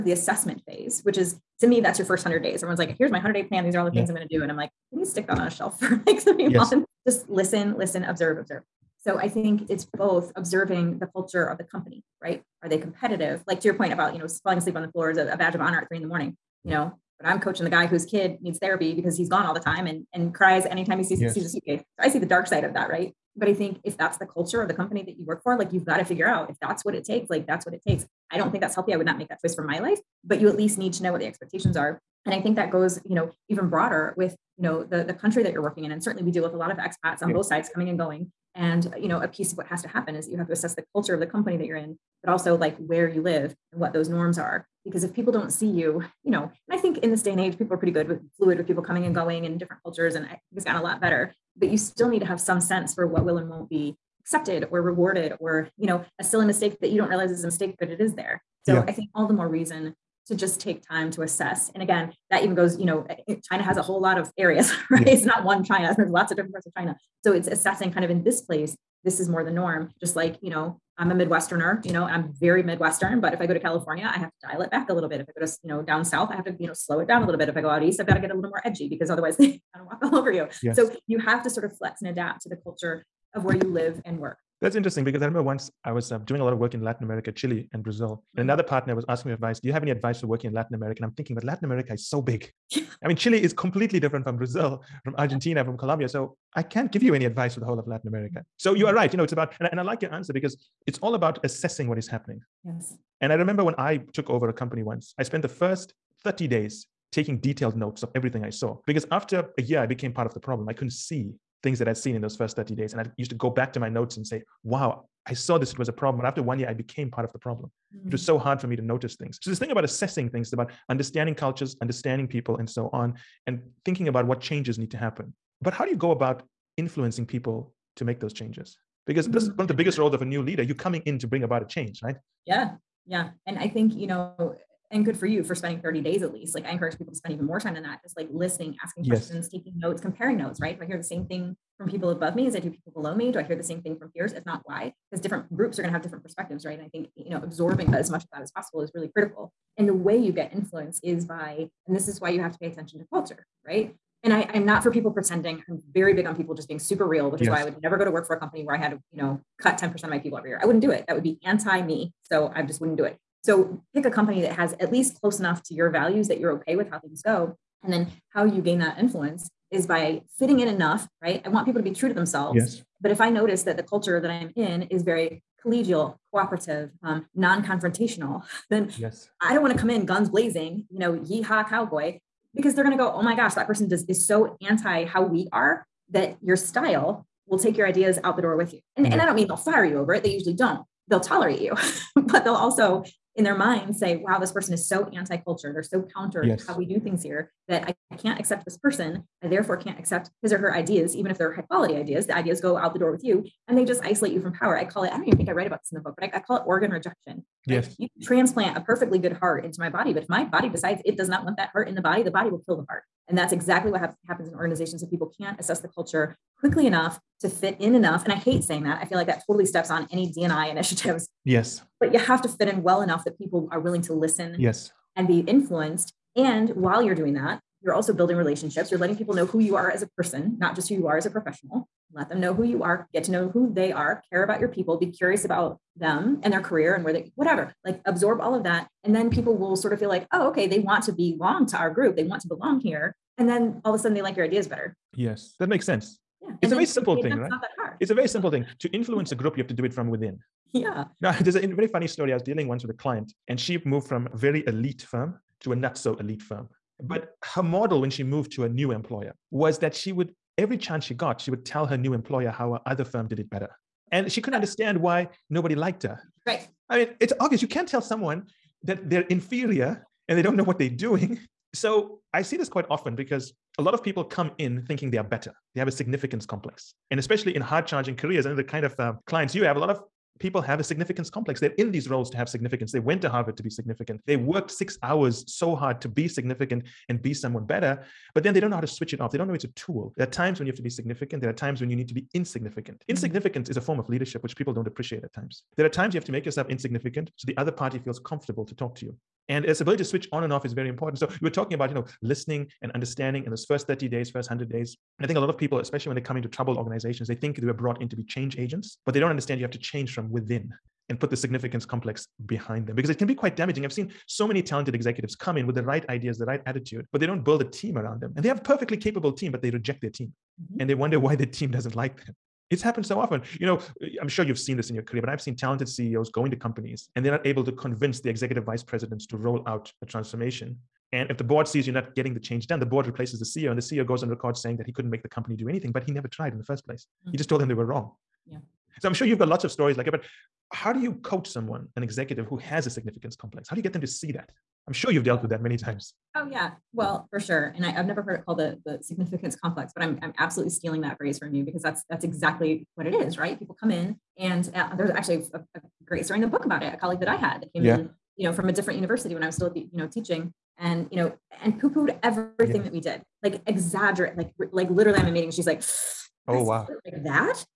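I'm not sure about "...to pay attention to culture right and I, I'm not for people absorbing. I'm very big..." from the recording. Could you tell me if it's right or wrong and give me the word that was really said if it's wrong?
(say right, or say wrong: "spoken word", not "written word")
wrong: "pretending", not "absorbing".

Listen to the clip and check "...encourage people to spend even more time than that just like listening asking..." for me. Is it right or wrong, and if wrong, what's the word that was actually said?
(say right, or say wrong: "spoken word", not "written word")
right.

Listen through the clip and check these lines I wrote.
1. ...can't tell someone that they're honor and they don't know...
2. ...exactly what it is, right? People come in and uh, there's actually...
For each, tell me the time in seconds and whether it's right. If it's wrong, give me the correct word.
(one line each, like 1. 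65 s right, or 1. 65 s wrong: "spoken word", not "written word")
1. 267 s wrong: "inferior", not "honor"
2. 352 s right.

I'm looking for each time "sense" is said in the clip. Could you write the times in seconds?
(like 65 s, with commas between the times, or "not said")
52 s, 245 s.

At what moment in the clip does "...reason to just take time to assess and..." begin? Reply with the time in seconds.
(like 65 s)
59 s.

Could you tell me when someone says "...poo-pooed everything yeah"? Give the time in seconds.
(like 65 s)
361 s.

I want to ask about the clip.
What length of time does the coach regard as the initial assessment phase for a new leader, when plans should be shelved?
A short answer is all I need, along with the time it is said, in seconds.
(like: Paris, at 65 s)
first hundred days, at 2 s.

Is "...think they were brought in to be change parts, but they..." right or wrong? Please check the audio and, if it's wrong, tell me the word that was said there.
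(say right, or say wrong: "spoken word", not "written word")
wrong: "agents", not "parts".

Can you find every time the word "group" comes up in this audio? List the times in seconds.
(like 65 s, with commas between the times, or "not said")
145 s, 241 s, 249 s.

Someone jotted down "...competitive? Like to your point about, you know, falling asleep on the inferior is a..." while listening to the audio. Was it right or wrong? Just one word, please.
wrong.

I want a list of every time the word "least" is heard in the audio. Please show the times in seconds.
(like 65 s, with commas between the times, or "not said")
30 s, 136 s, 164 s.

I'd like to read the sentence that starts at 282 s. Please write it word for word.
They went to Harvard to be significant.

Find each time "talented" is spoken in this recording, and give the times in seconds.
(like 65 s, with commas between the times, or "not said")
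314 s, 325 s.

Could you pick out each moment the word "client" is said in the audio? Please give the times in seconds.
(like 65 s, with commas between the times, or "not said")
252 s, 279 s.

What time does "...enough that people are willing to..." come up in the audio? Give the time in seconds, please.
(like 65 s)
223 s.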